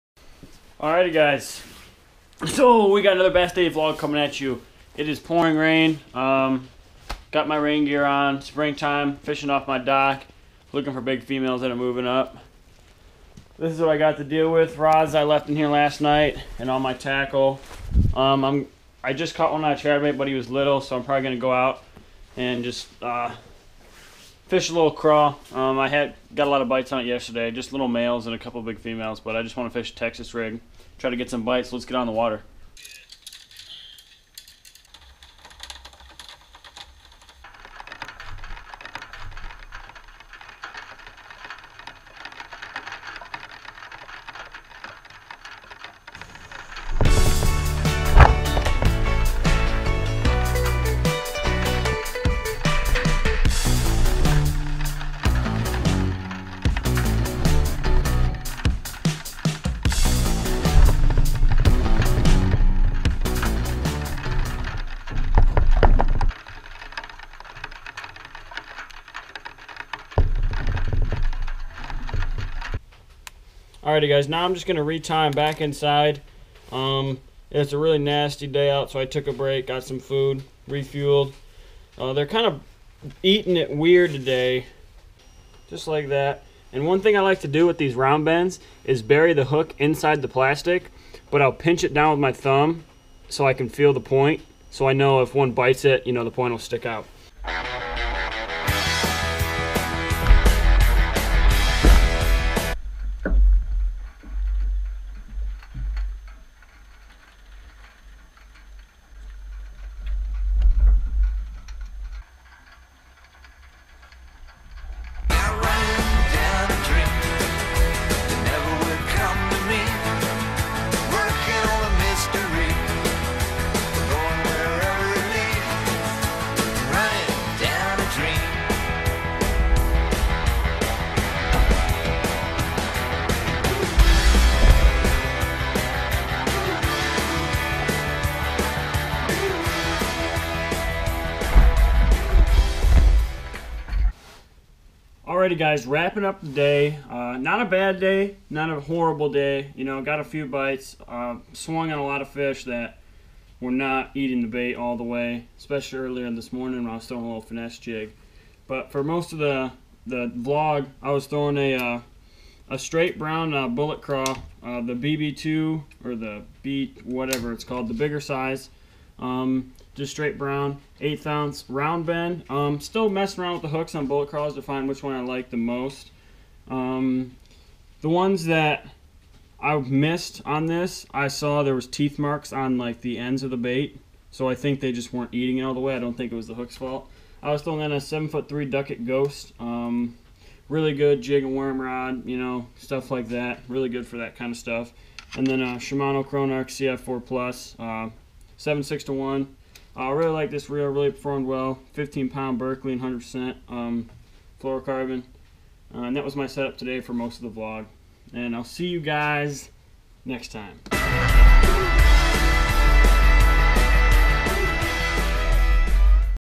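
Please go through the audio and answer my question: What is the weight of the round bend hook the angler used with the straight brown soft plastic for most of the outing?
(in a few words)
1/8 ounce.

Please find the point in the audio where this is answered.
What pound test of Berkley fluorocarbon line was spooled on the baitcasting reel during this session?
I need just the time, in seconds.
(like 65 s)
201 s.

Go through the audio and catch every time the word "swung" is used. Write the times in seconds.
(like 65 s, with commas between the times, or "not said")
151 s.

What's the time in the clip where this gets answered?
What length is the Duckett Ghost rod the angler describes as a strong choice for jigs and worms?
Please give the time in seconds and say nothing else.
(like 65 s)
188 s.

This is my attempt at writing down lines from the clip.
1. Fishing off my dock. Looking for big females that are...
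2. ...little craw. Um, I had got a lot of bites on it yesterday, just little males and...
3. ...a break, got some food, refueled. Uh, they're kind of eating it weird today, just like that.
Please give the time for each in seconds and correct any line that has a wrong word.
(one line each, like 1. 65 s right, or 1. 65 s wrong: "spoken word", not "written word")
1. 9 s right
2. 24 s right
3. 79 s right.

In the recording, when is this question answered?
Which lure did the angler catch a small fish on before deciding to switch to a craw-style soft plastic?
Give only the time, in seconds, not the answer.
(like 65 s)
19 s.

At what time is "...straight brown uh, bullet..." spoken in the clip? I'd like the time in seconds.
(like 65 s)
162 s.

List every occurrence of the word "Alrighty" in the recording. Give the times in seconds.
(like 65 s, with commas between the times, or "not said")
0 s, 73 s, 145 s.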